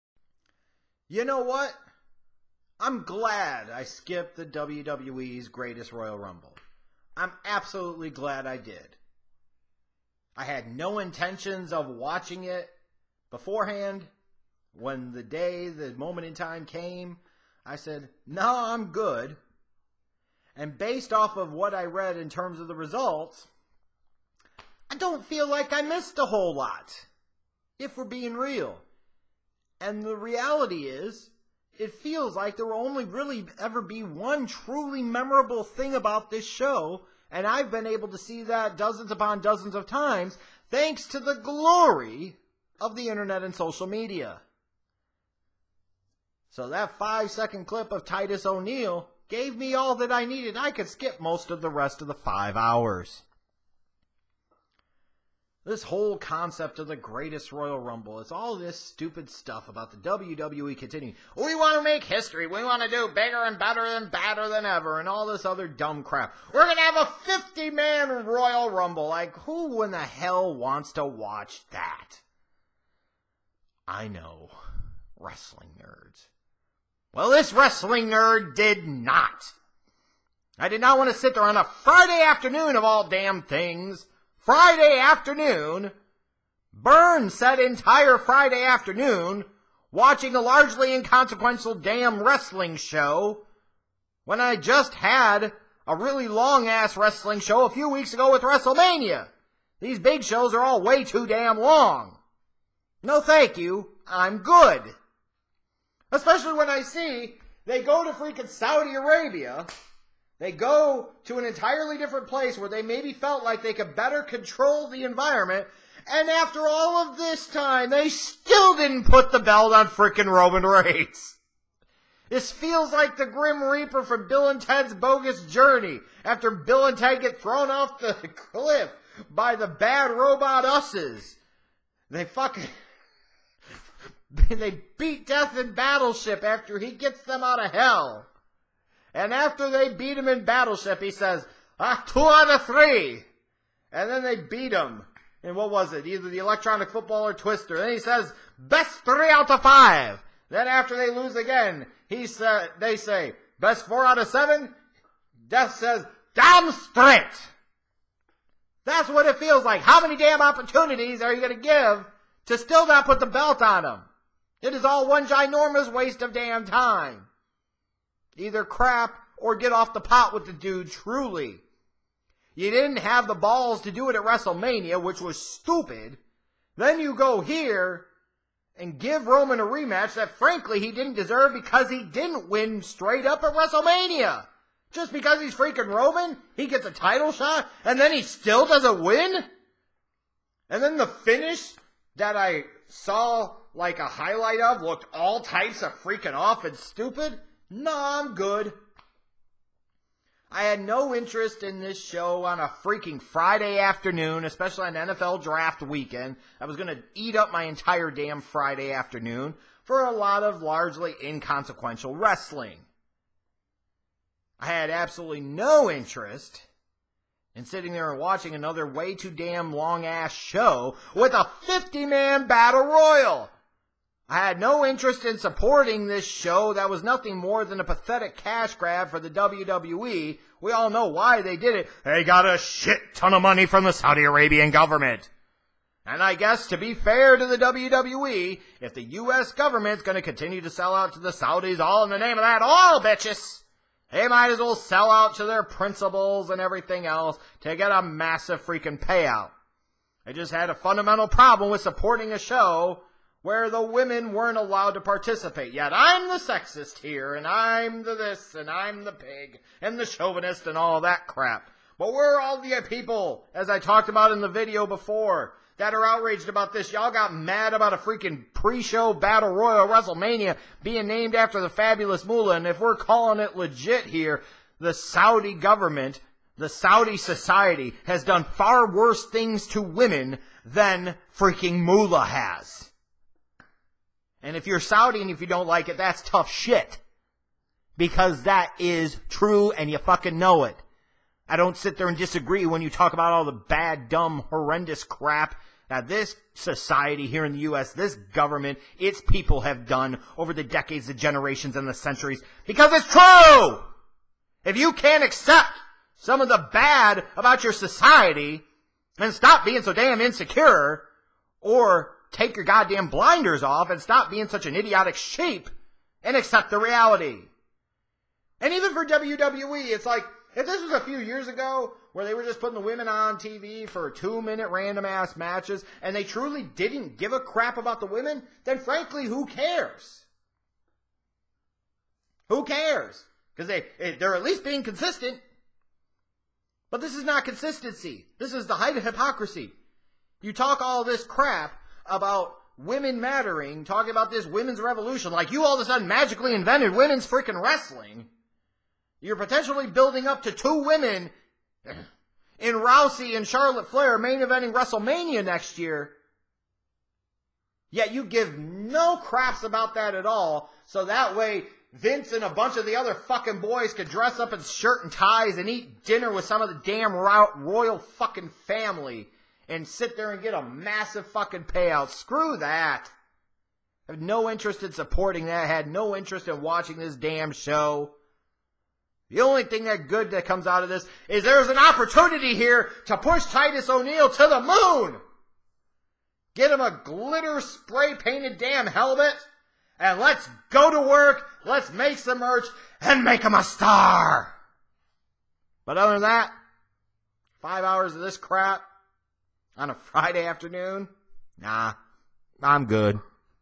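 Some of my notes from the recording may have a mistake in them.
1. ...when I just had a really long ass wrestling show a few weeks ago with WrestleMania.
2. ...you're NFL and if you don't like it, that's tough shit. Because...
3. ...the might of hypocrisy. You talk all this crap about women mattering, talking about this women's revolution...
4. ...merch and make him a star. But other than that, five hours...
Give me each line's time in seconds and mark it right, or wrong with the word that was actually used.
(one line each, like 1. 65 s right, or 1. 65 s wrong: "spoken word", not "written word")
1. 94 s right
2. 284 s wrong: "Saudi", not "NFL"
3. 338 s wrong: "height", not "might"
4. 392 s right.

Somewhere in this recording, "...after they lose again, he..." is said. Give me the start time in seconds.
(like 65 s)
150 s.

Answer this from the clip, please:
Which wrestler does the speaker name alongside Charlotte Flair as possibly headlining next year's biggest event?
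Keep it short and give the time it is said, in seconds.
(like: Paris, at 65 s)
Rousey, at 352 s.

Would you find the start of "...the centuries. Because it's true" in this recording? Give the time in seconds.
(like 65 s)
301 s.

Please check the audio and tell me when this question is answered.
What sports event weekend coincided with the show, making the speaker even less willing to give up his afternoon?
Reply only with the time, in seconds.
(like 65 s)
204 s.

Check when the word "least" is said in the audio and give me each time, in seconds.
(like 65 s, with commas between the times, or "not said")
334 s.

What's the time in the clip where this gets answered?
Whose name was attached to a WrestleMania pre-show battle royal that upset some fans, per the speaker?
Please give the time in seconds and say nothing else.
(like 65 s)
271 s.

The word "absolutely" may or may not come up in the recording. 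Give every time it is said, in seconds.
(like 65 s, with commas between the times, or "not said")
7 s, 214 s.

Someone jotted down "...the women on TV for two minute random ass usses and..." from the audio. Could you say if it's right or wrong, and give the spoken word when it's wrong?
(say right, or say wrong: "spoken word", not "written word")
wrong: "matches", not "usses".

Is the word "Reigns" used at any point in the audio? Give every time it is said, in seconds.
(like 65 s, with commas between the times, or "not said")
120 s.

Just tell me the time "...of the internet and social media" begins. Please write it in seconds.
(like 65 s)
42 s.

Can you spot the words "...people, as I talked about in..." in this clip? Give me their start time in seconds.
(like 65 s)
262 s.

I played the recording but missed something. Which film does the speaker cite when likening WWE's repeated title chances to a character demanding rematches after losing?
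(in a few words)
Bill and Ted's Bogus Journey.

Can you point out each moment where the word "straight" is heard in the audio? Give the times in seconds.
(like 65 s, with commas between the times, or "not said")
156 s, 182 s.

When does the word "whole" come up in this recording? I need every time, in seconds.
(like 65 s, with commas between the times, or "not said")
26 s, 55 s.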